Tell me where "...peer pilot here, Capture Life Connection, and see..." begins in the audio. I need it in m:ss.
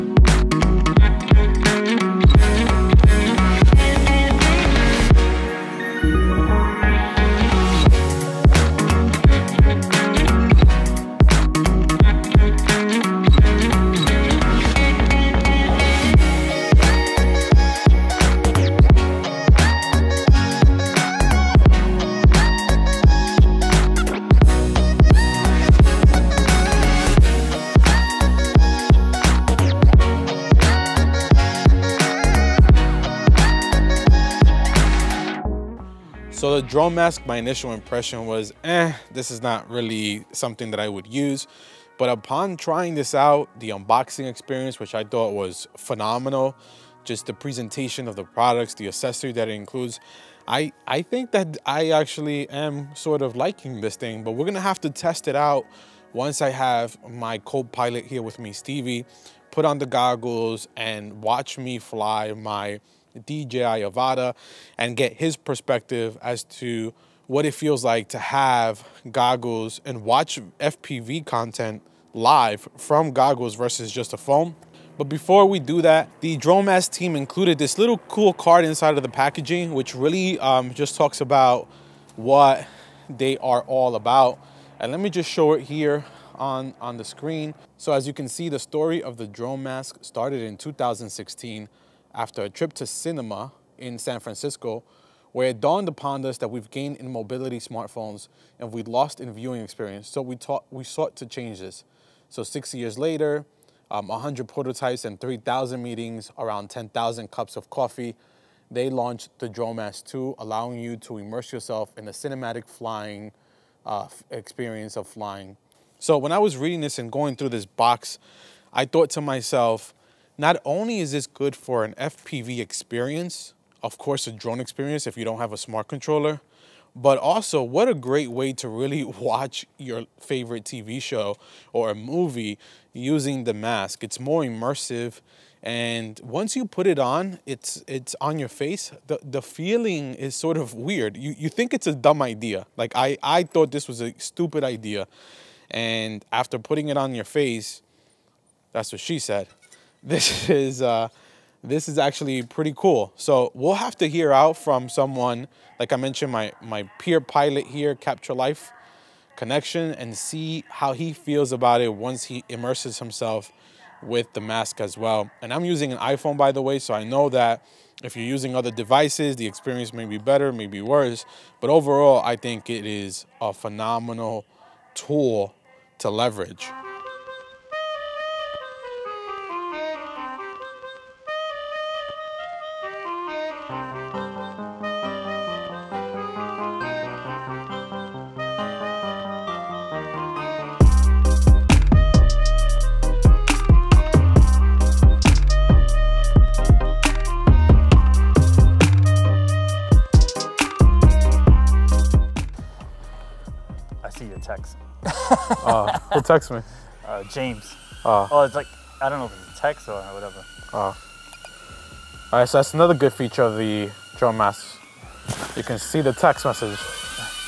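2:36.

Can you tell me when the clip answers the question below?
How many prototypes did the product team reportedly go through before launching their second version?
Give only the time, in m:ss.
1:44.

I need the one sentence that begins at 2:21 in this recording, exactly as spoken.
You you think it's a dumb idea.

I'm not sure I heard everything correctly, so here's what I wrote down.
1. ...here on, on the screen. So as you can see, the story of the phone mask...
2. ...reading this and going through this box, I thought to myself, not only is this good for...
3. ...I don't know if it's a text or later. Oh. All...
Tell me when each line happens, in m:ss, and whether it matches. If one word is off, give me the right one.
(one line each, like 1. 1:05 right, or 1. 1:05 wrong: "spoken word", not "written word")
1. 1:25 wrong: "drone", not "phone"
2. 1:56 right
3. 3:29 wrong: "whatever", not "later".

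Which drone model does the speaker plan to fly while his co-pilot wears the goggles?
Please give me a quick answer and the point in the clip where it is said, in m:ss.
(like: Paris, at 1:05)
DJI Avata, at 1:03.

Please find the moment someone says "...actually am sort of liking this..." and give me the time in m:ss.
0:51.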